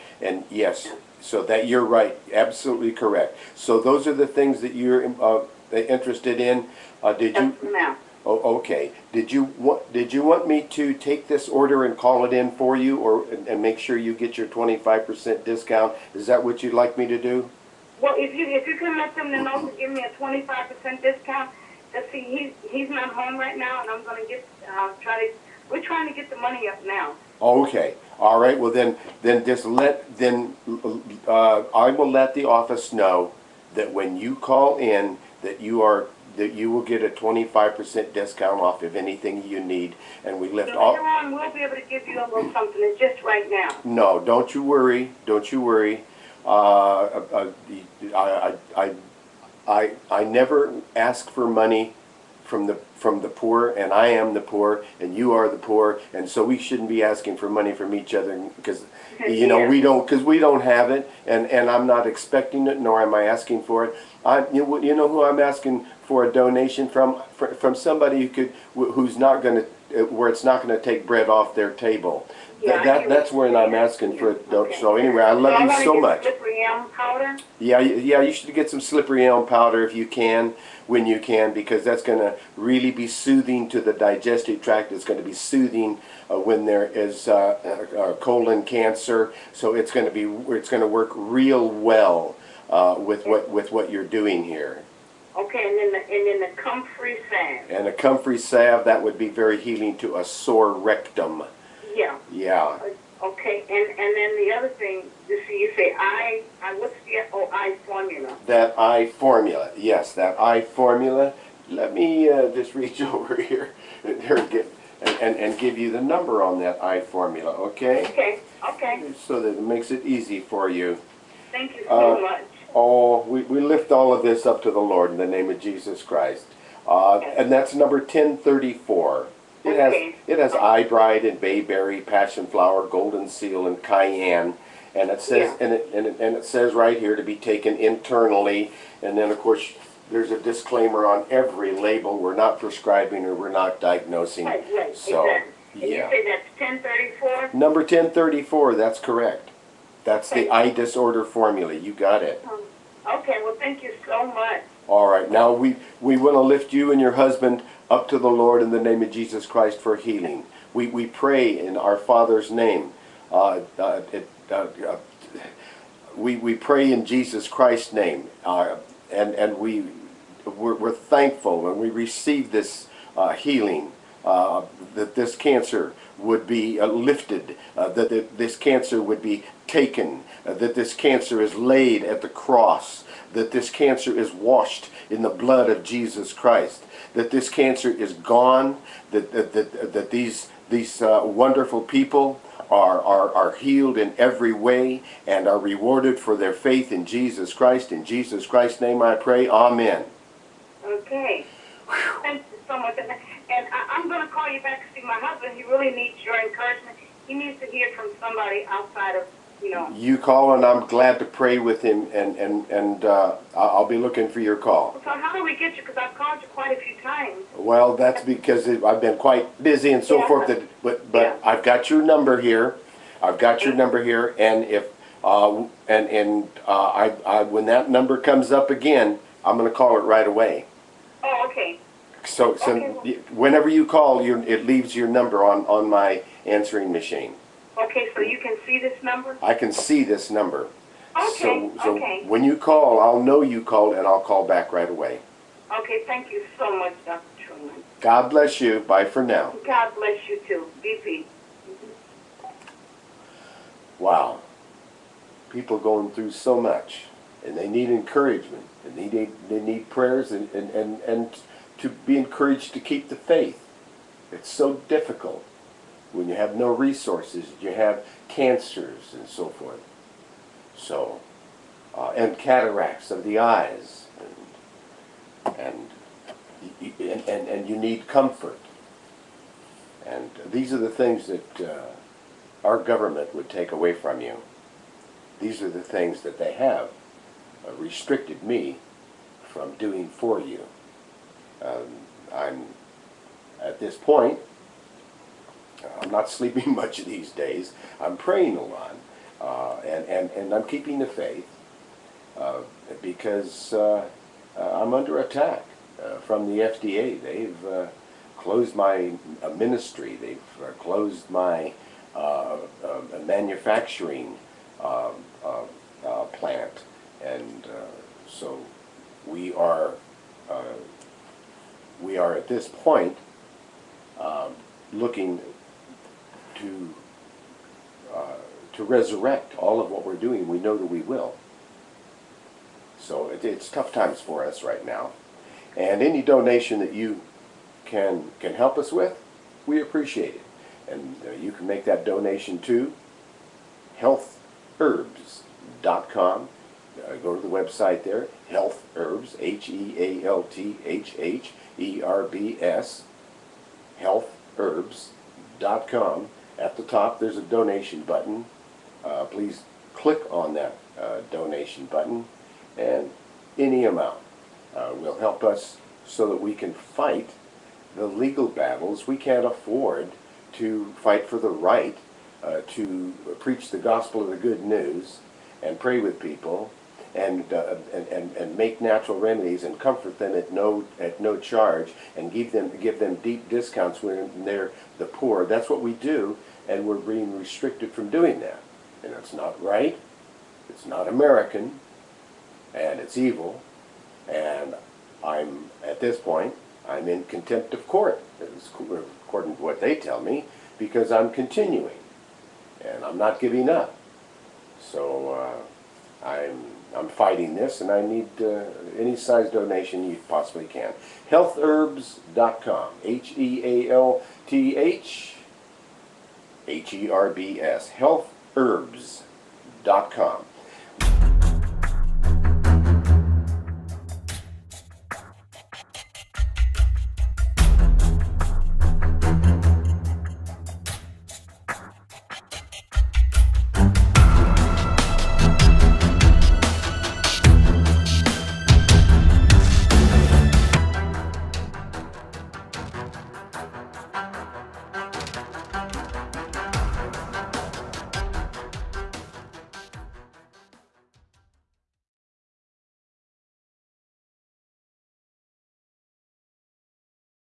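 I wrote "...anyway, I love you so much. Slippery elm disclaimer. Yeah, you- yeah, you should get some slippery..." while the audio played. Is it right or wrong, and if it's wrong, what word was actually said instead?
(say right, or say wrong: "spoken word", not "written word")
wrong: "powder", not "disclaimer".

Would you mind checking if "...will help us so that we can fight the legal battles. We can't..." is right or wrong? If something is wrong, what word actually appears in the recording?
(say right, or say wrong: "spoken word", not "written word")
right.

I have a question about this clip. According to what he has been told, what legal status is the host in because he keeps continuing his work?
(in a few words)
contempt of court.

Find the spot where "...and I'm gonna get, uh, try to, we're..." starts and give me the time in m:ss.
0:23.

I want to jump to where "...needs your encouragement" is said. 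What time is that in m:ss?
3:25.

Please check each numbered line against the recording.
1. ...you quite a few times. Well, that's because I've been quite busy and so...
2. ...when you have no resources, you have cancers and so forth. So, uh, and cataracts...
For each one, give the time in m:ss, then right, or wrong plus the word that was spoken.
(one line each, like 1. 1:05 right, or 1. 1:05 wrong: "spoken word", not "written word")
1. 3:36 right
2. 4:26 right.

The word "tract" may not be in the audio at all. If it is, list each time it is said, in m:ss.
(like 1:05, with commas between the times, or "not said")
1:24.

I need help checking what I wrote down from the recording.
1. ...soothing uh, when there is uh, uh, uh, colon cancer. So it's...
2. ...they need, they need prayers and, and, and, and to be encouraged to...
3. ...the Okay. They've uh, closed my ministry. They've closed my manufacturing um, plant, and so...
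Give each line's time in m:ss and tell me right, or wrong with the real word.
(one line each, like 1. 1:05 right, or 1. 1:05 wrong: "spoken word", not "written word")
1. 1:25 right
2. 4:18 right
3. 5:06 wrong: "FDA", not "Okay".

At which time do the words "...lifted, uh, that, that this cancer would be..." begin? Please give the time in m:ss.
2:56.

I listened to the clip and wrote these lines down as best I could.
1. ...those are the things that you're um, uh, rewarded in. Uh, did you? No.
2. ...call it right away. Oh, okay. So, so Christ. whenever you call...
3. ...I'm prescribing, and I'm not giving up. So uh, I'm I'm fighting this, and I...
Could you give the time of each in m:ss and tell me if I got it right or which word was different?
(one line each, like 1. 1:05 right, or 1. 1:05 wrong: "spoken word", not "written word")
1. 0:03 wrong: "interested", not "rewarded"
2. 3:49 wrong: "Okay", not "Christ"
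3. 6:41 wrong: "continuing", not "prescribing".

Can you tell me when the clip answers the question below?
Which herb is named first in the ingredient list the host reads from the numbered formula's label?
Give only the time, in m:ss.
2:10.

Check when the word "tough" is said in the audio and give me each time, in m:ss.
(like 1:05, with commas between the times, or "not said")
5:33.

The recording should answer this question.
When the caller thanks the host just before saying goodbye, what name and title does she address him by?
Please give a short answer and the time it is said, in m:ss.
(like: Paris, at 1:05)
Dr. Truman, at 4:07.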